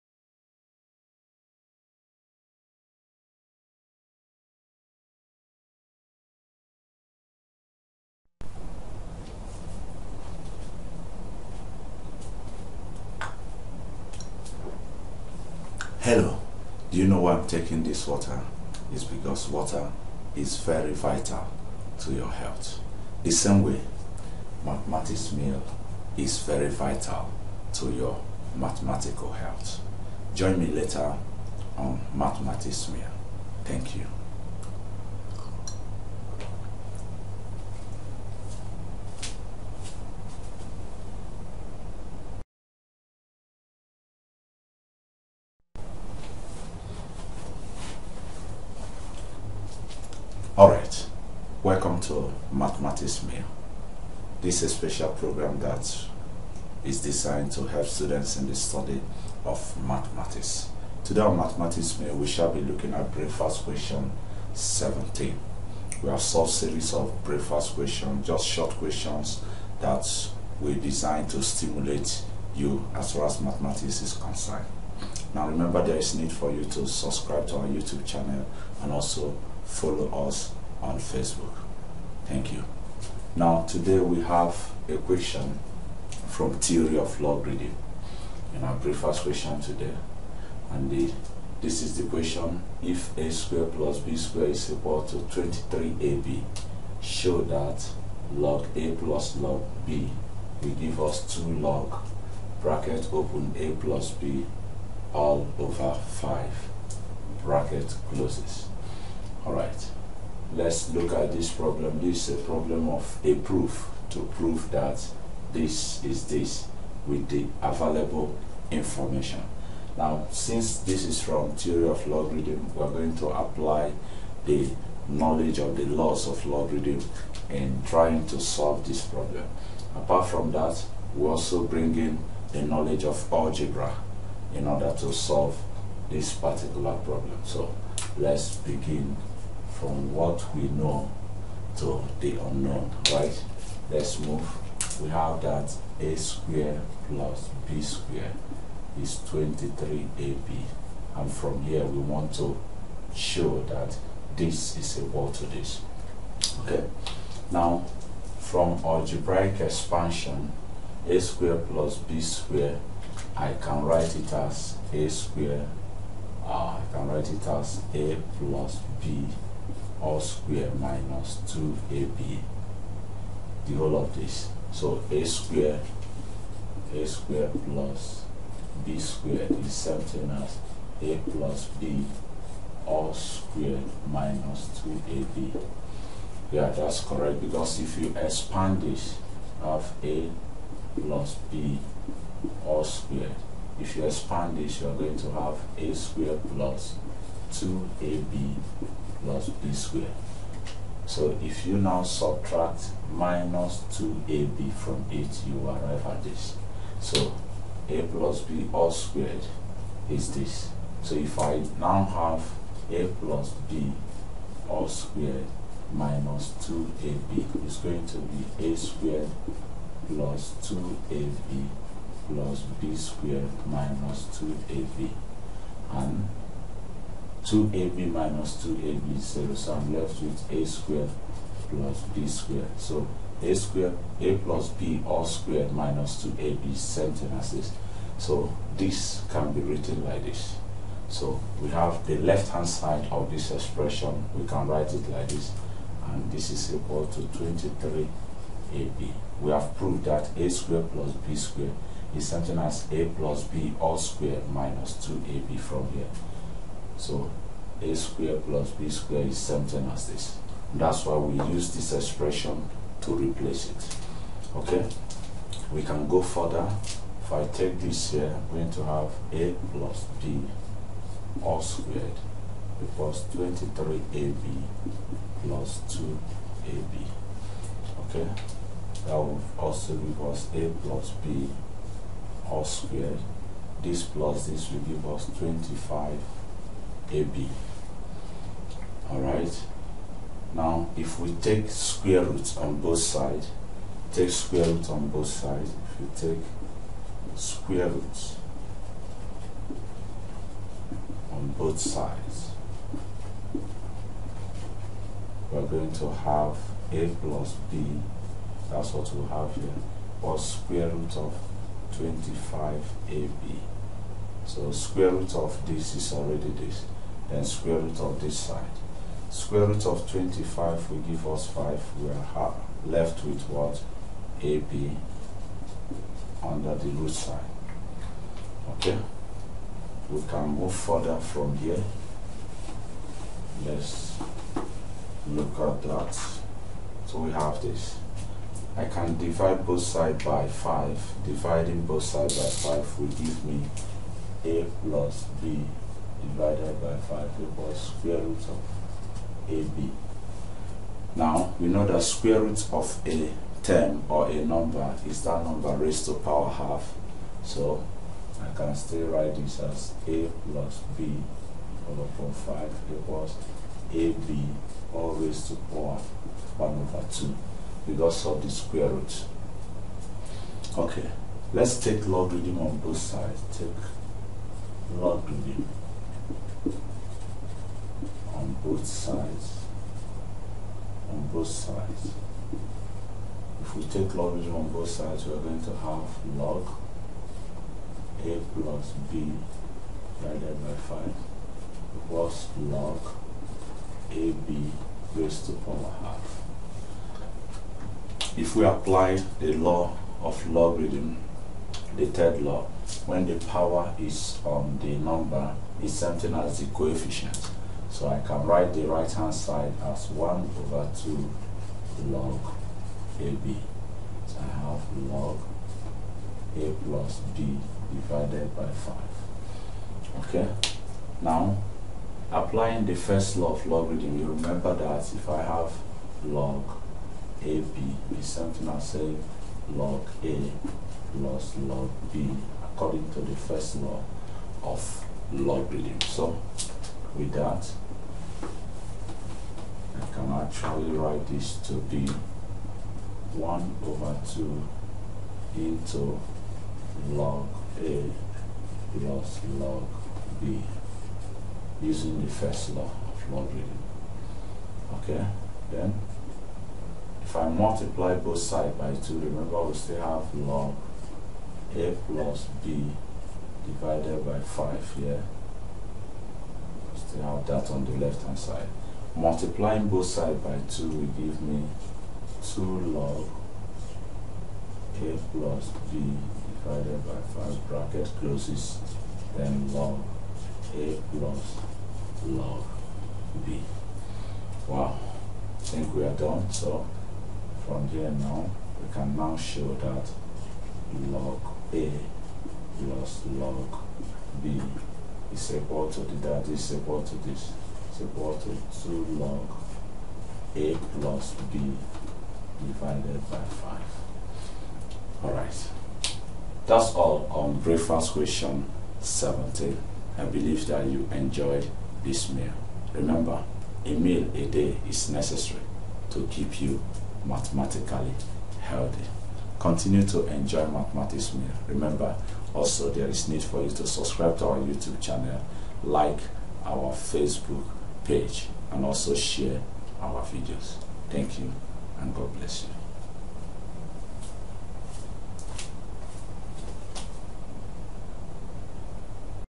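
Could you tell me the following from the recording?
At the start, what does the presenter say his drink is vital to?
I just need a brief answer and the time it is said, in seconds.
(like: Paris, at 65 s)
your health, at 19 s.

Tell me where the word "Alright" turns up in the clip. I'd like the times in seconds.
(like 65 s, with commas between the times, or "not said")
50 s, 289 s, 505 s.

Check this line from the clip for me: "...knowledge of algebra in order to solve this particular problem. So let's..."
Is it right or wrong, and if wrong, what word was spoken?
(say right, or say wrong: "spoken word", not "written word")
right.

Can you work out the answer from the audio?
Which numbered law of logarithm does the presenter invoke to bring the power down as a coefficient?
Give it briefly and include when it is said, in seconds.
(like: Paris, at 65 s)
third law, at 401 s.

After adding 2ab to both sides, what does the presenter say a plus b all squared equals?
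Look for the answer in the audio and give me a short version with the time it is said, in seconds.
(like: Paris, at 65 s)
25ab, at 285 s.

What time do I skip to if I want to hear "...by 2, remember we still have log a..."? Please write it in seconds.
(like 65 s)
458 s.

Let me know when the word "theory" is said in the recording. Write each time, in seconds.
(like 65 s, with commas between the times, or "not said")
86 s, 121 s.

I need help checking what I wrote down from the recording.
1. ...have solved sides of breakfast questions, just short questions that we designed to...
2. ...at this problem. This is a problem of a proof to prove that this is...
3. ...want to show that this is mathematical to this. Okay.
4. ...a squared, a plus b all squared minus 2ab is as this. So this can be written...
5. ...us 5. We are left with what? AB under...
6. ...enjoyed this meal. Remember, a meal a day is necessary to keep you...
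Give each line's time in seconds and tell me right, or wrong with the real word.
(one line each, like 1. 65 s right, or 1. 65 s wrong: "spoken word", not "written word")
1. 66 s wrong: "series", not "sides"
2. 111 s right
3. 151 s wrong: "equal", not "mathematical"
4. 233 s right
5. 321 s right
6. 511 s right.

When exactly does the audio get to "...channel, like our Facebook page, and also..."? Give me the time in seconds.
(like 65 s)
524 s.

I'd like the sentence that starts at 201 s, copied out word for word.
So if you now subtract minus 2ab from it, you arrive at this.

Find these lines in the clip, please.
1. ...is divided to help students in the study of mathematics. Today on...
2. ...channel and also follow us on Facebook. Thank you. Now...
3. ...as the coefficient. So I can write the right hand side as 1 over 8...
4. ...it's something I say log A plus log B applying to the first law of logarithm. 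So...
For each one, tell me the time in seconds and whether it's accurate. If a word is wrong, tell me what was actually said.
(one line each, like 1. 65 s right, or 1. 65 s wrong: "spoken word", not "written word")
1. 56 s wrong: "designed", not "divided"
2. 78 s right
3. 406 s wrong: "2", not "8"
4. 428 s wrong: "according", not "applying".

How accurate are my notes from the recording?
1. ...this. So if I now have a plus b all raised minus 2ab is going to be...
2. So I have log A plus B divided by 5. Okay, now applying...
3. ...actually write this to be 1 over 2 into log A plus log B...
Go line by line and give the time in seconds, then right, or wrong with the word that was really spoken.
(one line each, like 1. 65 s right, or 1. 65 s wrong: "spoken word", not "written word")
1. 210 s wrong: "squared", not "raised"
2. 414 s right
3. 440 s right.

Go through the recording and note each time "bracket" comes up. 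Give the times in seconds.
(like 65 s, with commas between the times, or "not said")
102 s, 107 s, 477 s.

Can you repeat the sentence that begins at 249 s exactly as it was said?
We have proved that a squared plus b squared is something as a plus b all squared minus 2ab from here.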